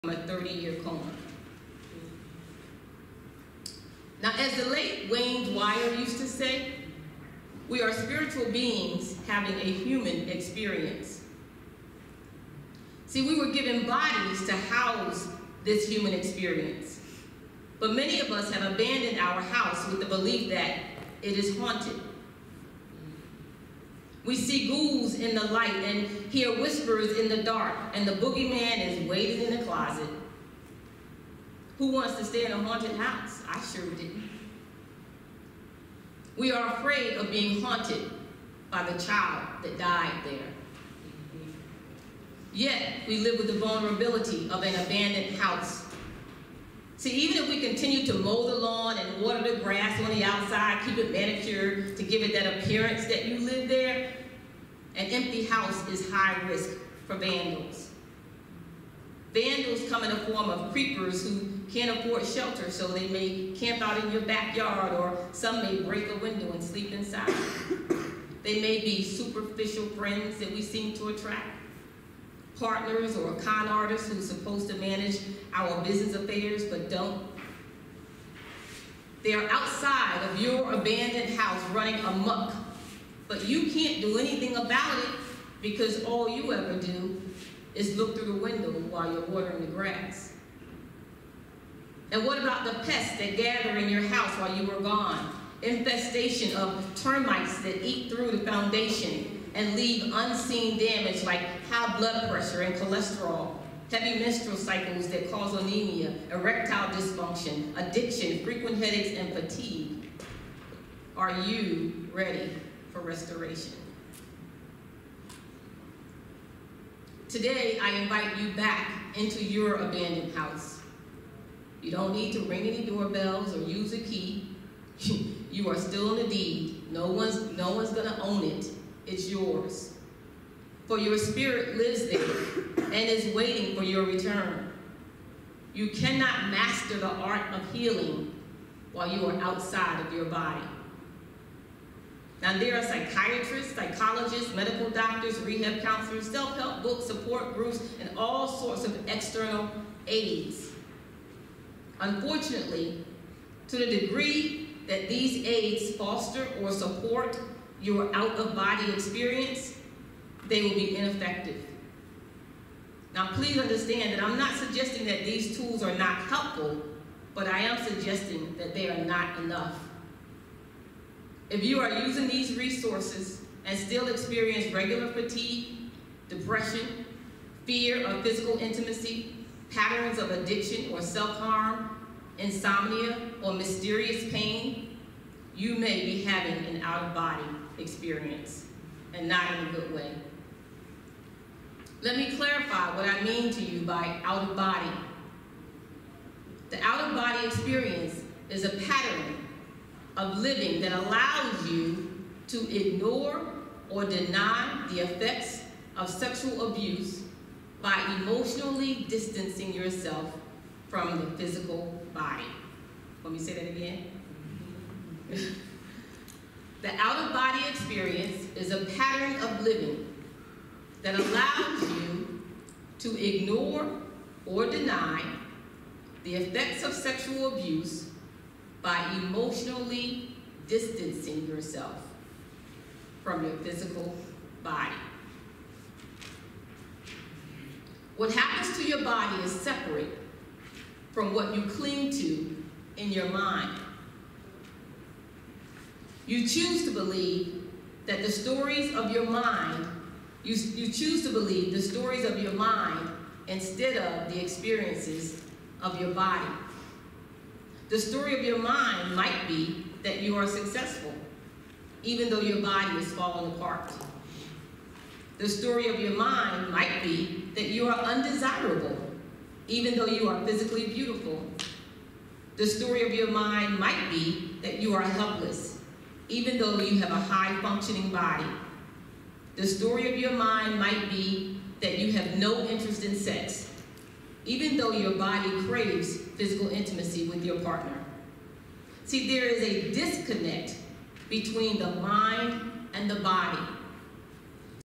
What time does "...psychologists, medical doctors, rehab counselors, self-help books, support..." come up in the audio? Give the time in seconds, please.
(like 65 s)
143 s.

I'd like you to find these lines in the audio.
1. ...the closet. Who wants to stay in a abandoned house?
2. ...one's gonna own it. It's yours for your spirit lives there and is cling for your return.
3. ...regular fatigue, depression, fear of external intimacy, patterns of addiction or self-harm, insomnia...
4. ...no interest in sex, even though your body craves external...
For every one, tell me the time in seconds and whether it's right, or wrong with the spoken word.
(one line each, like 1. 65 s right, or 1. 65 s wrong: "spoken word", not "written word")
1. 29 s wrong: "haunted", not "abandoned"
2. 127 s wrong: "waiting", not "cling"
3. 174 s wrong: "physical", not "external"
4. 282 s wrong: "physical", not "external".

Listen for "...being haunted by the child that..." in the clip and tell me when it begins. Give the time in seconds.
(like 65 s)
37 s.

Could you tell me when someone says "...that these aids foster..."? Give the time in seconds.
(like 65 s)
154 s.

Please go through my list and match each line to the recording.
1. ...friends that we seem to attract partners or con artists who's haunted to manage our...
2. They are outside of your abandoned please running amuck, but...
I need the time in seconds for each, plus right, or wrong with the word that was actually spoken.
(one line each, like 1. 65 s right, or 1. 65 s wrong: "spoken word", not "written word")
1. 69 s wrong: "supposed", not "haunted"
2. 79 s wrong: "house", not "please".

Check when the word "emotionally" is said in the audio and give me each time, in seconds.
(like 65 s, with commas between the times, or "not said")
208 s, 229 s.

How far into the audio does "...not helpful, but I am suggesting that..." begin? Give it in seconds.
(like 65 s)
165 s.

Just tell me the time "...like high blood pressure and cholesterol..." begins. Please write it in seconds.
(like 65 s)
101 s.